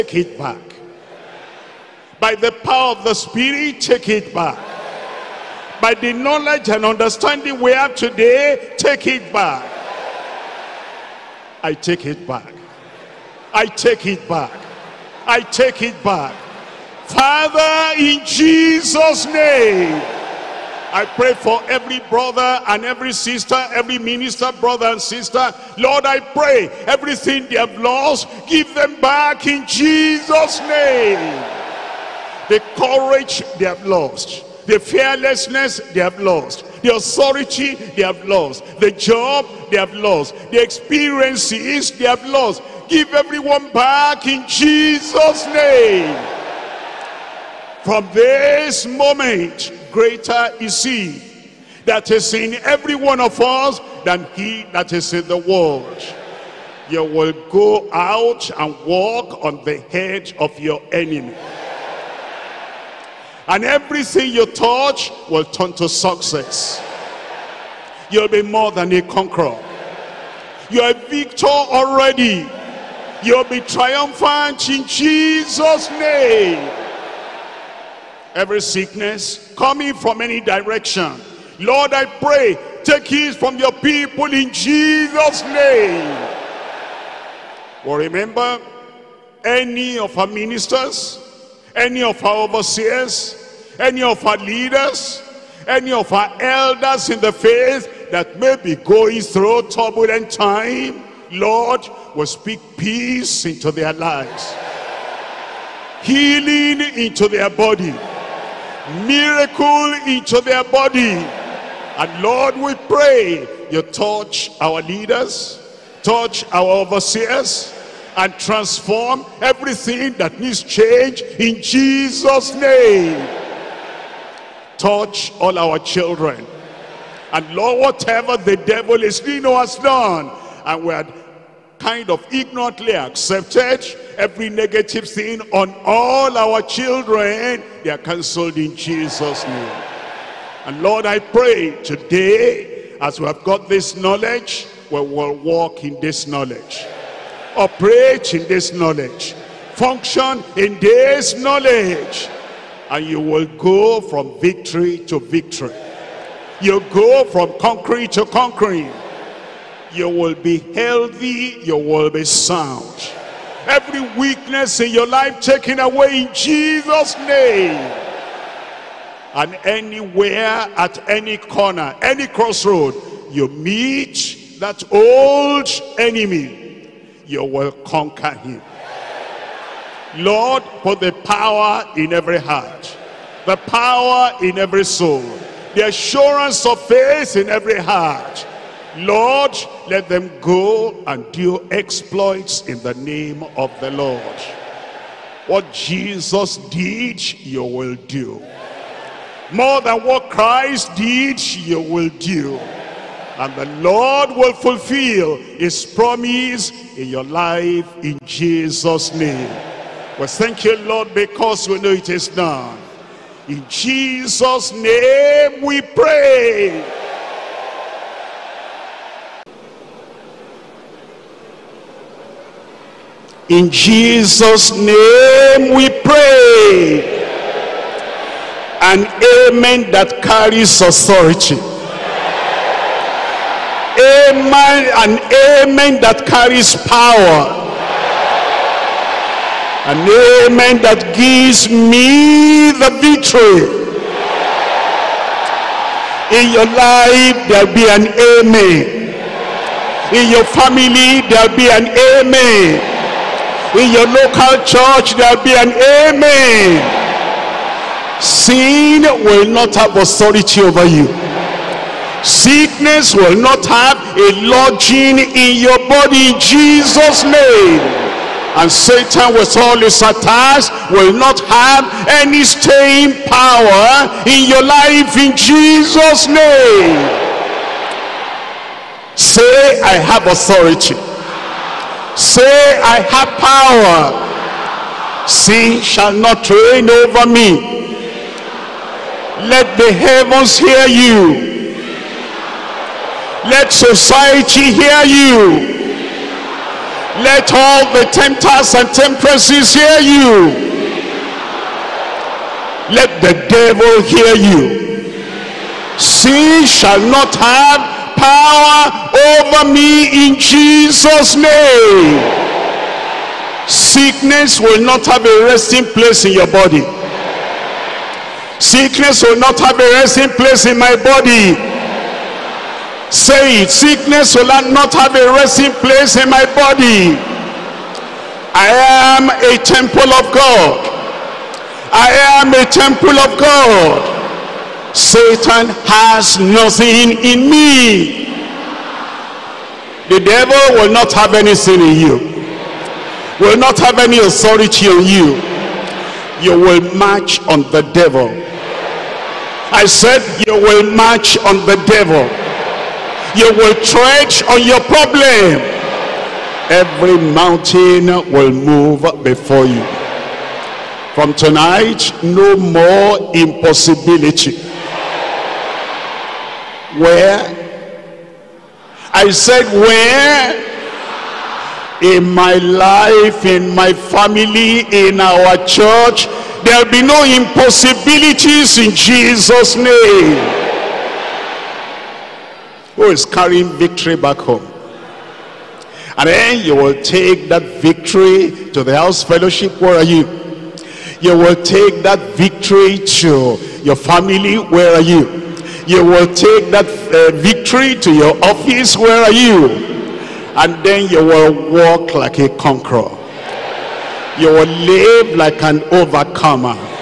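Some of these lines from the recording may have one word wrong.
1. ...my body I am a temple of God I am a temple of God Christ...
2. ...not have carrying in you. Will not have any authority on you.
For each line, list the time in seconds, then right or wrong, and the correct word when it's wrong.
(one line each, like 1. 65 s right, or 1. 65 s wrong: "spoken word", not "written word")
1. 326 s wrong: "Satan", not "Christ"
2. 340 s wrong: "anything", not "carrying".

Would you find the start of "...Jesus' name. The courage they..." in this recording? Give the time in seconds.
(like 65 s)
29 s.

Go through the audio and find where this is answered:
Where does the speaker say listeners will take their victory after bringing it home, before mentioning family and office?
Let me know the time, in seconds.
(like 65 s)
388 s.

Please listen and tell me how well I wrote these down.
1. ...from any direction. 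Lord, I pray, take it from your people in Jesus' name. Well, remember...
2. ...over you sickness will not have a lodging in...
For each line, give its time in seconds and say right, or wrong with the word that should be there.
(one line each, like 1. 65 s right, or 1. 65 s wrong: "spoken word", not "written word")
1. 79 s right
2. 260 s right.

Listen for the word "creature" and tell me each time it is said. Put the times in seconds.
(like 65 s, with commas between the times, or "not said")
not said.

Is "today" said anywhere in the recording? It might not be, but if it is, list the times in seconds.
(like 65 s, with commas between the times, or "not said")
7 s, 141 s.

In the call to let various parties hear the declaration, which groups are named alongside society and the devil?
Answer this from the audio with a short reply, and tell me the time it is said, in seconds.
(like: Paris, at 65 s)
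tempters and temptresses, at 298 s.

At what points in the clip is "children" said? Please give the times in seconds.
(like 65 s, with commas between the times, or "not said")
125 s, 136 s.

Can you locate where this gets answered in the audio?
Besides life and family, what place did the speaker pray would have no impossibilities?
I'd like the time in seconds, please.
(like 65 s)
374 s.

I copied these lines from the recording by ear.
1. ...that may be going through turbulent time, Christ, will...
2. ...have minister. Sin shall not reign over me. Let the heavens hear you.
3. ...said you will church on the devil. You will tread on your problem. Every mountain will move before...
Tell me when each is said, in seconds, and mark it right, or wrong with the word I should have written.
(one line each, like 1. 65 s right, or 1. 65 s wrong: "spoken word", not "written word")
1. 98 s wrong: "Lord", not "Christ"
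2. 283 s wrong: "power", not "minister"
3. 349 s wrong: "march", not "church".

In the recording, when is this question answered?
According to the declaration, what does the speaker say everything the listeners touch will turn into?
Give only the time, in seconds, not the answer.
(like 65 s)
65 s.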